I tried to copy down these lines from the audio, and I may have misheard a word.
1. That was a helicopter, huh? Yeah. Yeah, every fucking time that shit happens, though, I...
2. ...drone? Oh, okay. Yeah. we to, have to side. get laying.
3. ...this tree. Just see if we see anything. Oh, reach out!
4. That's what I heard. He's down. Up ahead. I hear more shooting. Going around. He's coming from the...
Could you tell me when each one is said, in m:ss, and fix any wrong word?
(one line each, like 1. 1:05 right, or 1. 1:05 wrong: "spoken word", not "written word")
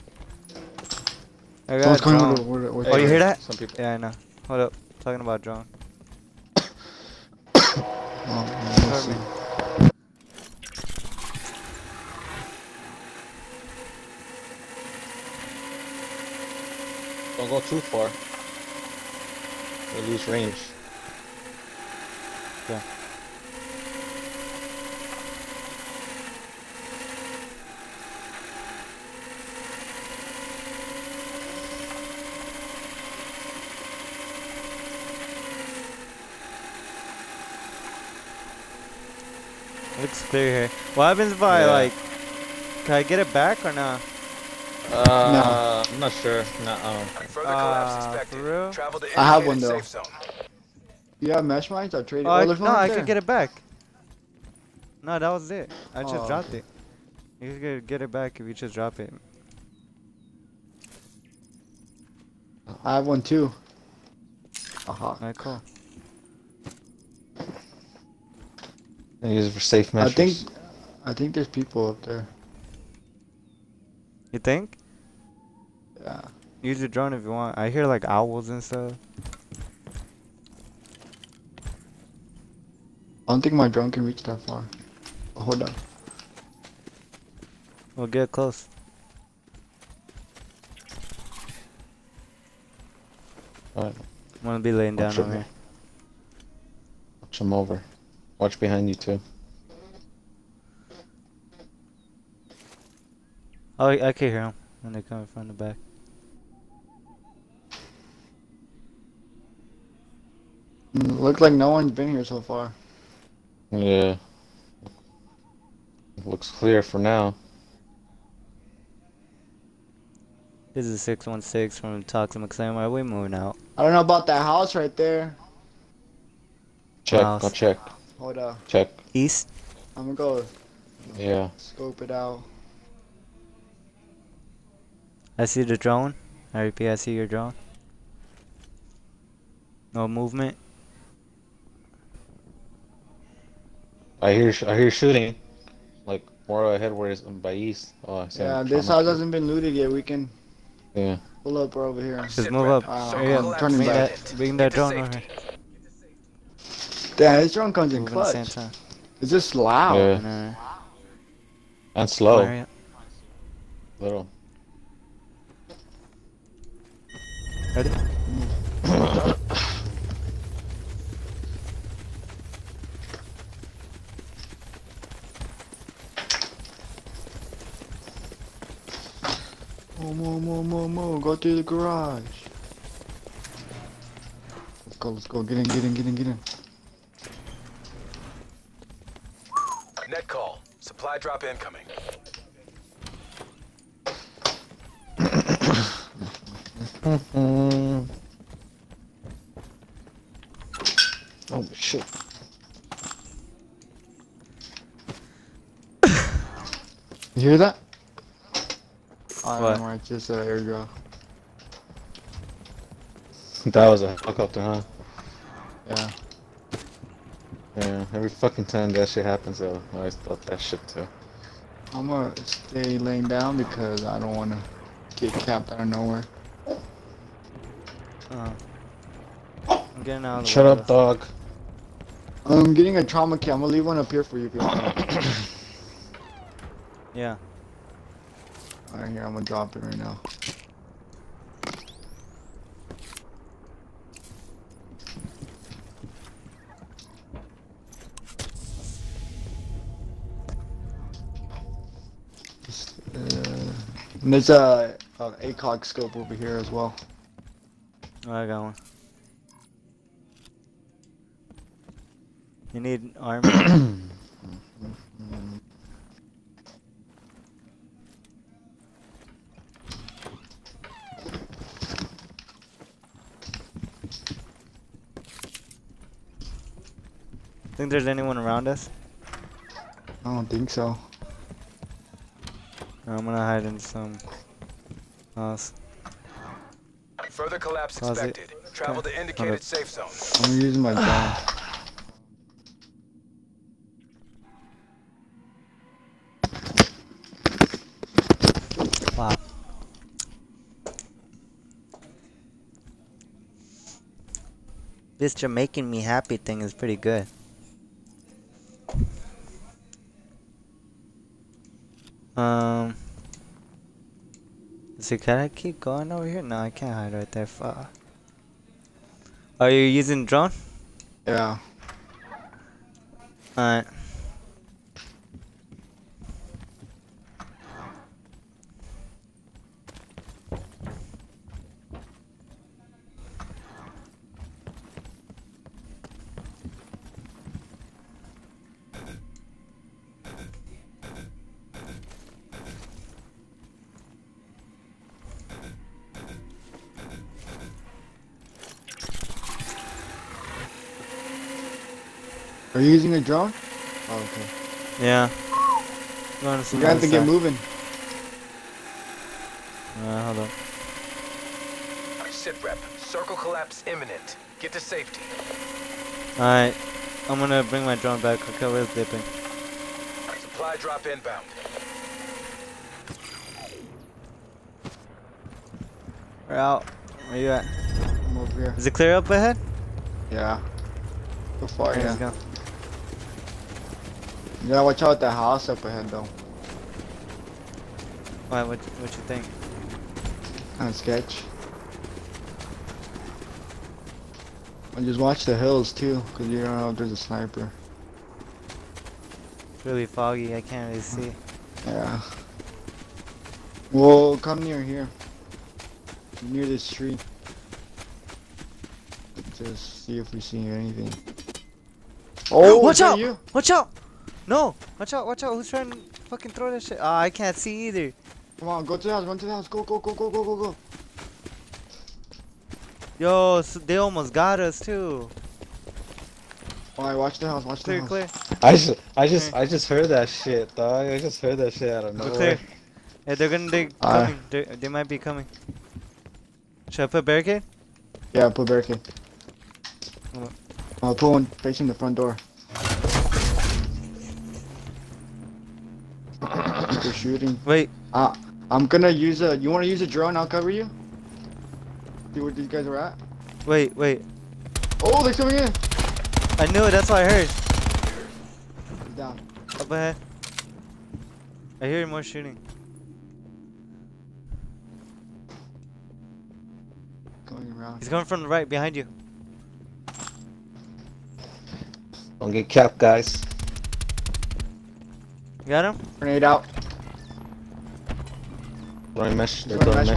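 1. 3:33 right
2. 5:53 wrong: "moving", not "laying"
3. 6:46 wrong: "watch", not "reach"
4. 7:36 right.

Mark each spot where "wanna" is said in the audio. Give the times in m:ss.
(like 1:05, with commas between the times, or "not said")
3:44, 7:29.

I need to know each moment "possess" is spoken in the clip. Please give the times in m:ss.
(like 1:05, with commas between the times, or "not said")
not said.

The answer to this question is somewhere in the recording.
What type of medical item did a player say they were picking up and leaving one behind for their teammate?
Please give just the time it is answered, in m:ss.
3:53.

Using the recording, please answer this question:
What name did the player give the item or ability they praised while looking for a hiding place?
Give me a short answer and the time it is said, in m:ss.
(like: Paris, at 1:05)
Jamaican me happy, at 5:05.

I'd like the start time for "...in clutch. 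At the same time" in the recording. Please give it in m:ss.
2:37.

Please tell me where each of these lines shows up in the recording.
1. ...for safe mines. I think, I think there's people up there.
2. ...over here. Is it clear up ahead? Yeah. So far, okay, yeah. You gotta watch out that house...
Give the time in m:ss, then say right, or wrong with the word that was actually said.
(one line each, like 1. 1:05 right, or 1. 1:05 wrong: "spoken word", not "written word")
1. 1:09 wrong: "measures", not "mines"
2. 6:18 right.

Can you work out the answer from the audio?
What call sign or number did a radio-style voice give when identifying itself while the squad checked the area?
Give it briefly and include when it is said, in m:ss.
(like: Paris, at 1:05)
616, at 2:01.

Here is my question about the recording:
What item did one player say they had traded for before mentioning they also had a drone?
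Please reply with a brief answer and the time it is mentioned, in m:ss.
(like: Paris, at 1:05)
mesh mines, at 0:51.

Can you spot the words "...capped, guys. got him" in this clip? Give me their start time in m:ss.
7:52.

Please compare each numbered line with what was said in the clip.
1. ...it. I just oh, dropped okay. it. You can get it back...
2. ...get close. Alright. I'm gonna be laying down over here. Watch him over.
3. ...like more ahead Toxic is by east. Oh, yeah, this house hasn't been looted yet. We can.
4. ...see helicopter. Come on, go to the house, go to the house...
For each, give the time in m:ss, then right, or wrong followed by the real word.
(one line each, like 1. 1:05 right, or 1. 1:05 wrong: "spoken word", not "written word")
1. 0:55 right
2. 1:28 right
3. 2:26 wrong: "Where", not "Toxic"
4. 6:57 wrong: "either", not "helicopter".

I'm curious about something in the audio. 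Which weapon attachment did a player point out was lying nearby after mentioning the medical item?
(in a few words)
ACOG scope.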